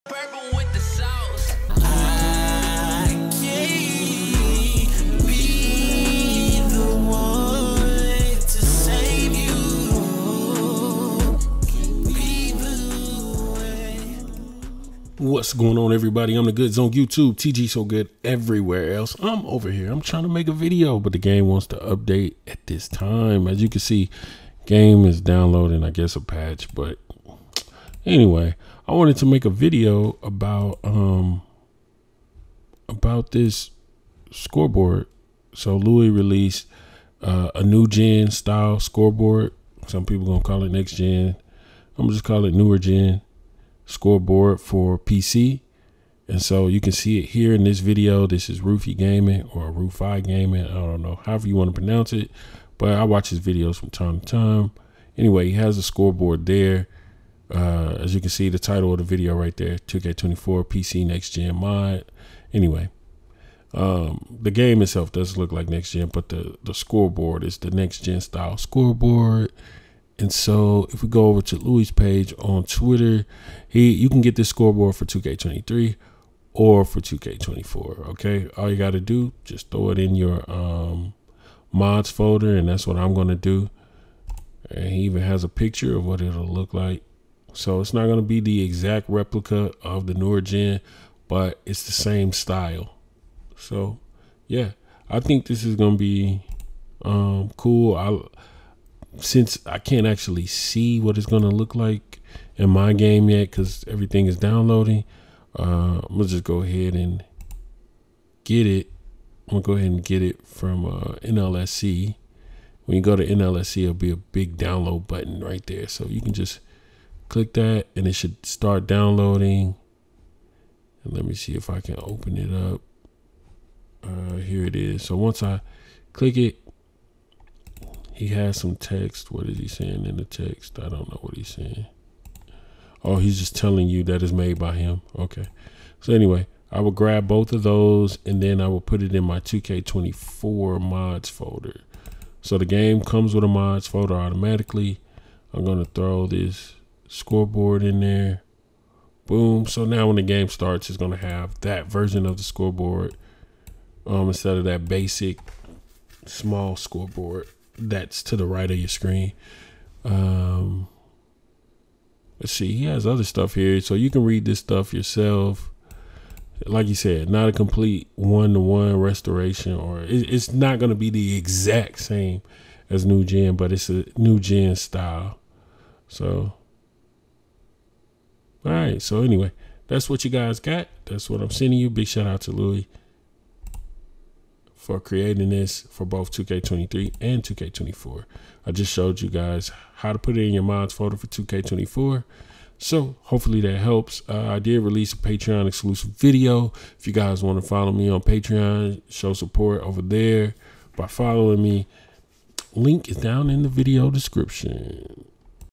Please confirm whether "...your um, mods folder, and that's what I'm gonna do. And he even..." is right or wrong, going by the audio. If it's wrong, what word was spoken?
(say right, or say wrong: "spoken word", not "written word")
right.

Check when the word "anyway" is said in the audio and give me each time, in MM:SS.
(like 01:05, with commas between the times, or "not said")
00:28, 00:55, 01:02, 02:16, 02:59.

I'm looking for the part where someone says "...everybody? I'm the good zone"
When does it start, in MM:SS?
00:15.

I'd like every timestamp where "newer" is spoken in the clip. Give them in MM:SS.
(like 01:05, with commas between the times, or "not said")
00:42, 01:30.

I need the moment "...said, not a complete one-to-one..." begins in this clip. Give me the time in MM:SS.
02:46.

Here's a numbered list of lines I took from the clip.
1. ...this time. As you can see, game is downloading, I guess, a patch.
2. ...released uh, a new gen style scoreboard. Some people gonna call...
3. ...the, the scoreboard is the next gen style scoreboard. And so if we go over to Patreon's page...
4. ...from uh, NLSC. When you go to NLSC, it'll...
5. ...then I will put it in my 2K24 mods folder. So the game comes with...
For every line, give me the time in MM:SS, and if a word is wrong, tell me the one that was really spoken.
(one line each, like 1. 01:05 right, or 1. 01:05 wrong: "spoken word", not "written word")
1. 00:22 right
2. 00:36 right
3. 01:06 wrong: "Looyh", not "Patreon"
4. 01:50 right
5. 02:18 right.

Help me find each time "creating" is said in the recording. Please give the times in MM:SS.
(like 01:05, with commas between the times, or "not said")
03:04.